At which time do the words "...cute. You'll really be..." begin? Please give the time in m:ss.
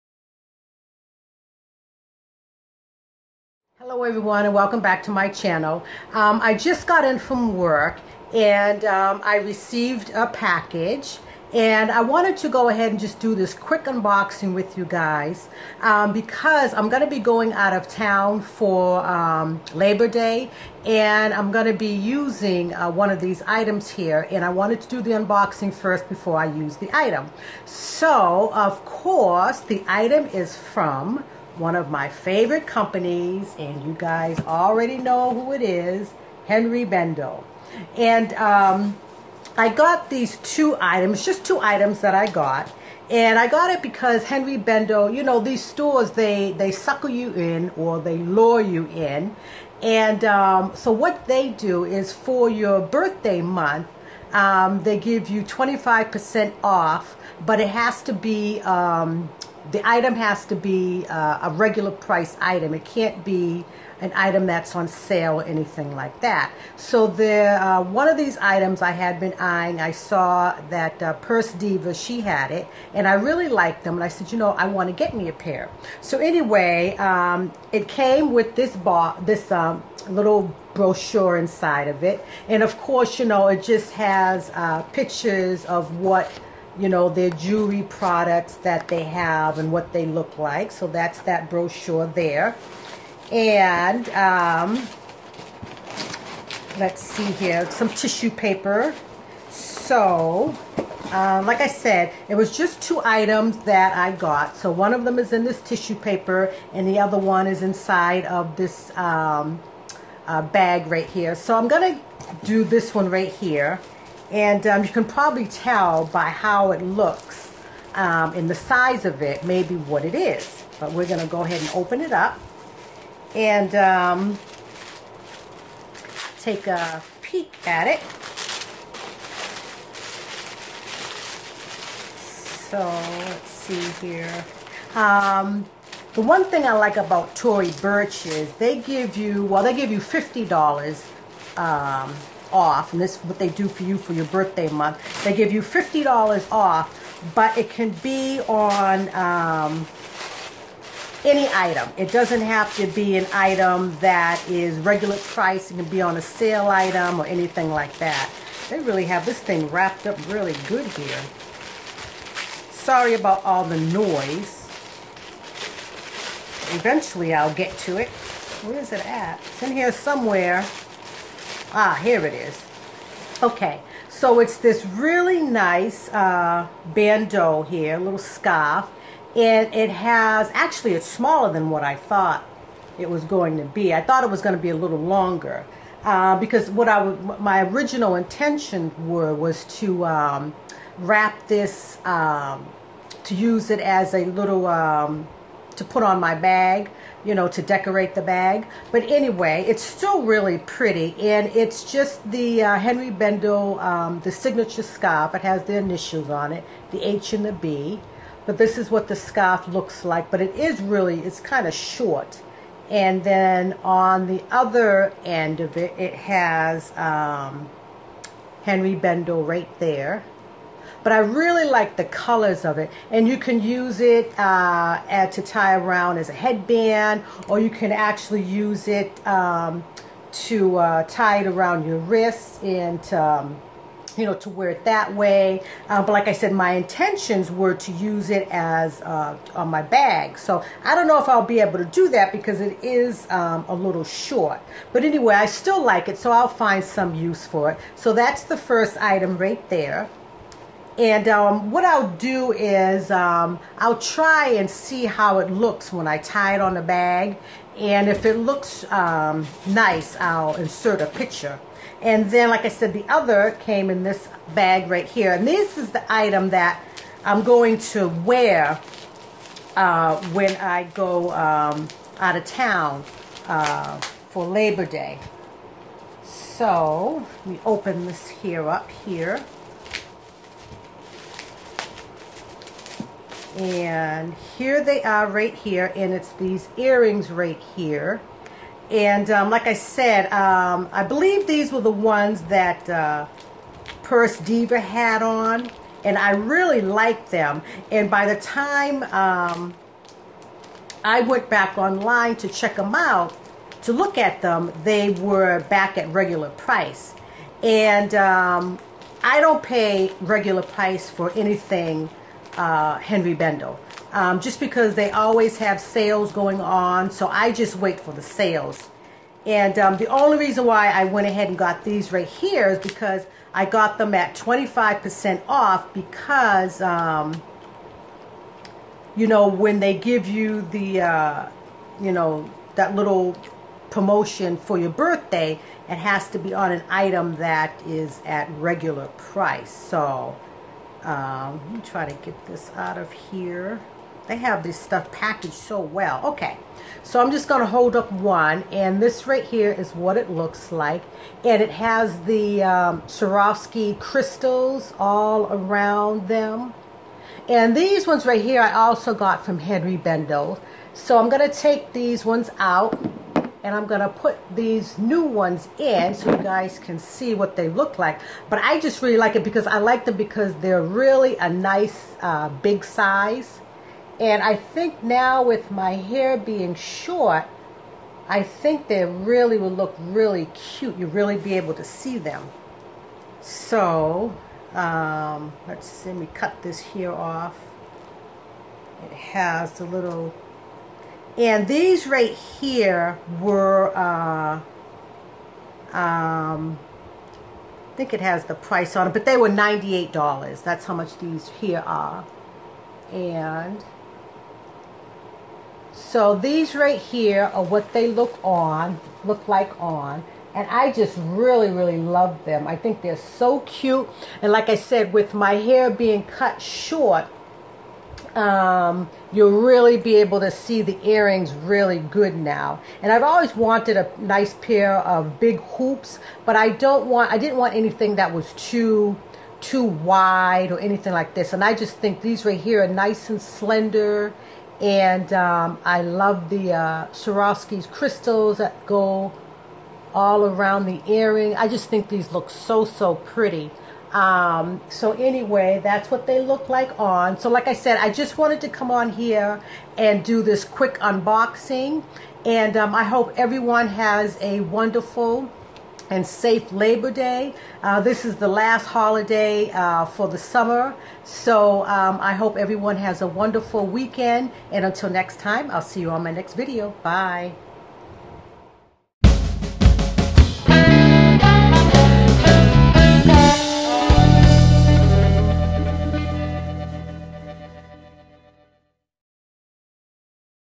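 6:20.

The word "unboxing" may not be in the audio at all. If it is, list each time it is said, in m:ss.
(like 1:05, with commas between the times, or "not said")
0:13, 0:25, 7:30.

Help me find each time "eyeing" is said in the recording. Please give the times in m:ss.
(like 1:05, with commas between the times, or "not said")
1:09.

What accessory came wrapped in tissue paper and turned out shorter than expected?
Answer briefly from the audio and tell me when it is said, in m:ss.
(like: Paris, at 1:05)
bandeau, at 2:56.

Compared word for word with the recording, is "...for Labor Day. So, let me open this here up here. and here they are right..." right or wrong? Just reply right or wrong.
right.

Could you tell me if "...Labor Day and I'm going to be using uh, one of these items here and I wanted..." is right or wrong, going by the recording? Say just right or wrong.
right.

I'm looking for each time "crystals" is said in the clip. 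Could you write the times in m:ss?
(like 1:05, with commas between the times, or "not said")
5:53, 7:17.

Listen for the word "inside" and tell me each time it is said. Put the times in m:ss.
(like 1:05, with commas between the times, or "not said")
1:21, 1:47.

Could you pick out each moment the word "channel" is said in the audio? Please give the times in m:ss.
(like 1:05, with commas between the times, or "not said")
0:05.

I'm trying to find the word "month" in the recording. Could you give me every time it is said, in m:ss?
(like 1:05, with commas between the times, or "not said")
0:53, 2:24.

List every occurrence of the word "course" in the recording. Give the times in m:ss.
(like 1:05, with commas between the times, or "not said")
0:28, 1:22.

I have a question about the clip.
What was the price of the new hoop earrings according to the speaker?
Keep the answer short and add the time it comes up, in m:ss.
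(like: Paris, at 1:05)
$98, at 6:39.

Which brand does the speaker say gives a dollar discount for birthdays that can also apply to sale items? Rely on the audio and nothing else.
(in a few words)
Tory Burch.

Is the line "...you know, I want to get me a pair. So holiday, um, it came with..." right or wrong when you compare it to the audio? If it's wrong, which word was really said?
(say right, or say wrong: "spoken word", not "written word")
wrong: "anyway", not "holiday".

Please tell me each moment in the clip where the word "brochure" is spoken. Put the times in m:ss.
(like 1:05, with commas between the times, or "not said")
1:20, 1:31.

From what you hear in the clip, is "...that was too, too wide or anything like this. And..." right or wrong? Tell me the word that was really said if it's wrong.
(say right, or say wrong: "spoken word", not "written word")
right.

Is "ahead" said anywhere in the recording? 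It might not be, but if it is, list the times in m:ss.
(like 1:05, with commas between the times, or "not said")
0:12, 2:01, 5:21.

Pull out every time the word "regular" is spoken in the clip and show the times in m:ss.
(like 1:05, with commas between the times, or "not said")
1:01, 2:34, 5:06, 5:10, 5:38.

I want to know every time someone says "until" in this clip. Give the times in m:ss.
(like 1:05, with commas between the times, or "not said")
7:44.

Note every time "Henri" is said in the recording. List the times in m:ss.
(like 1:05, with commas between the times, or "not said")
0:36, 0:44, 3:22, 3:38, 5:12, 5:59.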